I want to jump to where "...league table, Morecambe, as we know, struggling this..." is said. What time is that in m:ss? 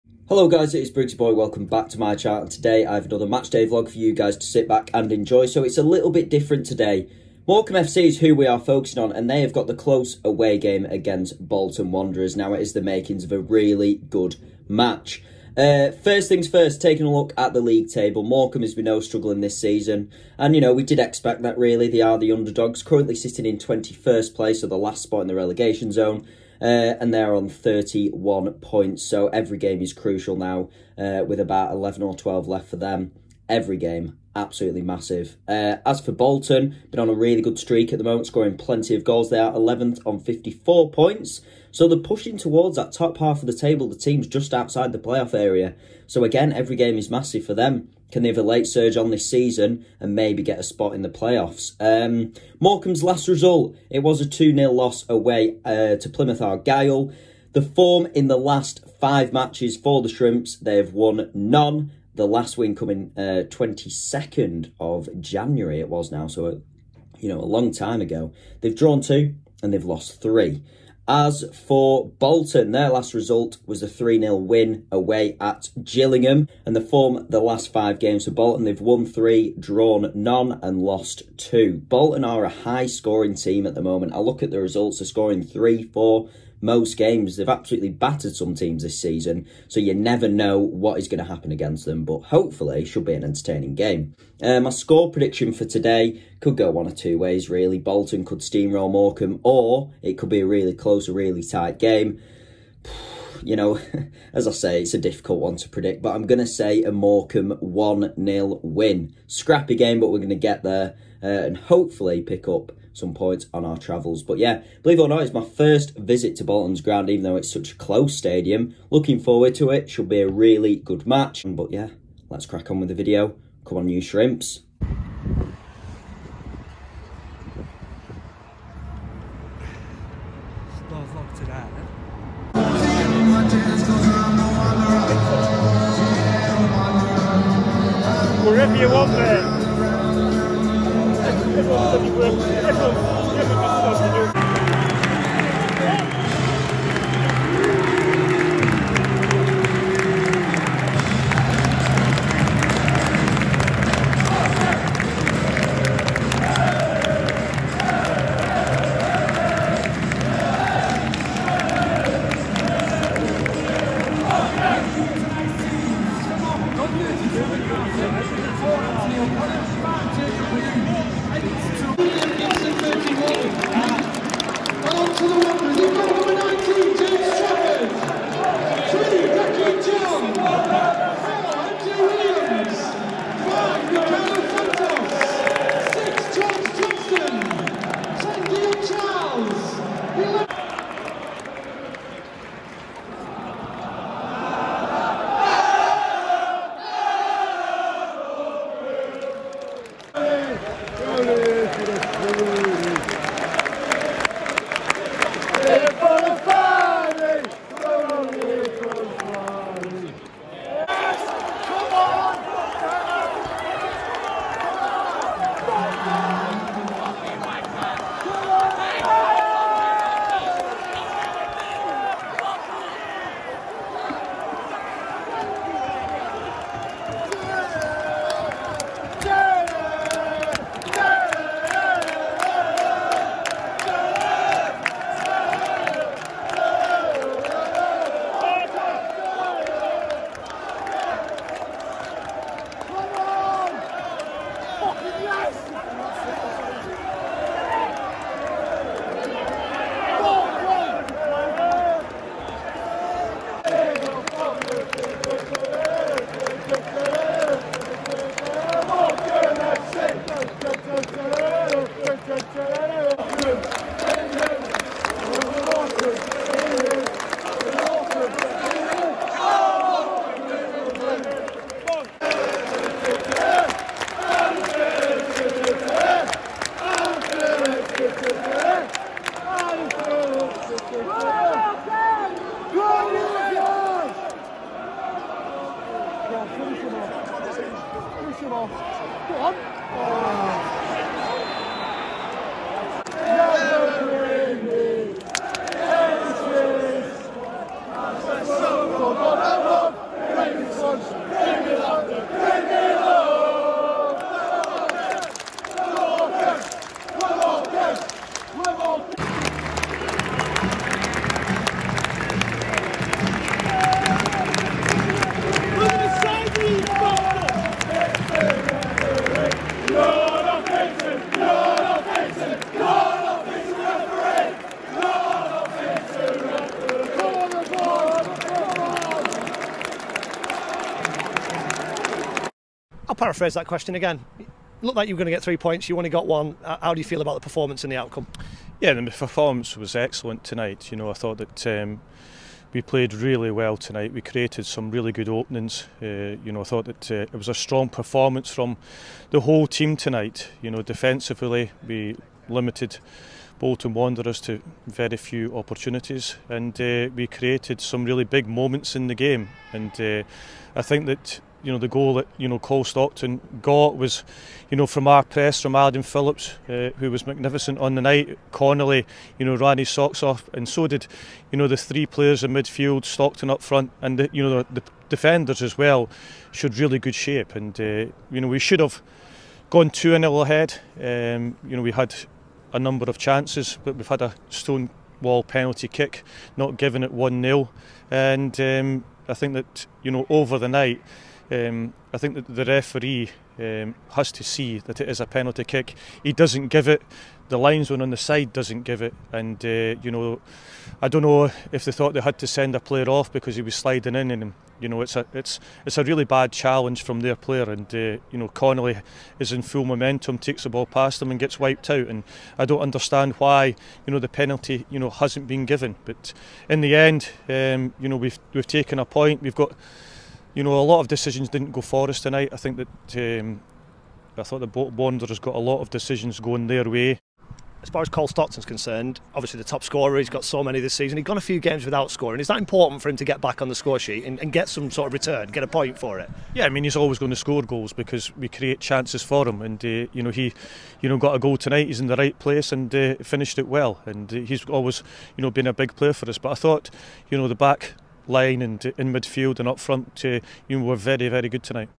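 0:17.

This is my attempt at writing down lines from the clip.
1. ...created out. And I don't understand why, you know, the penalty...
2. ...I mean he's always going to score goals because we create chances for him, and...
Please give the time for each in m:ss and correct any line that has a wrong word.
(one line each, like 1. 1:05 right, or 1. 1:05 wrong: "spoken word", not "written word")
1. 6:51 wrong: "wiped", not "created"
2. 7:16 right.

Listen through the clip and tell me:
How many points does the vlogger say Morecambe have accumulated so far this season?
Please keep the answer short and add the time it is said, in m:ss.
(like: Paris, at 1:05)
31, at 0:27.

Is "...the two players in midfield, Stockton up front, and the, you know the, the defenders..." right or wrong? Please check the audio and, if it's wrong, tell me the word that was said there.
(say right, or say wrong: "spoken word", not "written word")
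wrong: "three", not "two".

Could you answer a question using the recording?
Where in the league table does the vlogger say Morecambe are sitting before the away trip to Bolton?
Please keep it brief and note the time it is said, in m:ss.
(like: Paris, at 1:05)
21st, at 0:23.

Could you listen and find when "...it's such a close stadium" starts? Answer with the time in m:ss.
1:57.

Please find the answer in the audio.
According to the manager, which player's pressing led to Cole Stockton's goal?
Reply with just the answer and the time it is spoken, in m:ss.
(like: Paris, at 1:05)
Adam Phillips, at 6:05.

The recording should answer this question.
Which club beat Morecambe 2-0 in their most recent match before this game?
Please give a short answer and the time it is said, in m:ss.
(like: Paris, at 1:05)
Plymouth Argyle, at 0:56.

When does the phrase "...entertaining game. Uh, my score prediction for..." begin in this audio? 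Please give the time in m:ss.
1:33.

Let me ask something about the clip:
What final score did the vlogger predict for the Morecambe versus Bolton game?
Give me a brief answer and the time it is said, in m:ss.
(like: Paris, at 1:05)
Morecambe 1-0 win, at 1:46.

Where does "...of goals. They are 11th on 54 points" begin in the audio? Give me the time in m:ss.
0:38.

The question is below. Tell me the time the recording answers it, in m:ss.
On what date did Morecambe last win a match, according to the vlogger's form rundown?
1:03.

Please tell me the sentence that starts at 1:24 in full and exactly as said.
I look at the results, they're scoring three, four, most games.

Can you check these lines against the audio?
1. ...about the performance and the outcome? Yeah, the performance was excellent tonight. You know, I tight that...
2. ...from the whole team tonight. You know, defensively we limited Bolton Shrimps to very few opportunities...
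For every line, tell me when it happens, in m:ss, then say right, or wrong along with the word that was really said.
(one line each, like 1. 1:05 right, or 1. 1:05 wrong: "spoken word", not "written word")
1. 5:37 wrong: "thought", not "tight"
2. 5:48 wrong: "Wanderers", not "Shrimps".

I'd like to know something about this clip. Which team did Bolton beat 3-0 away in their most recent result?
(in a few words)
Gillingham.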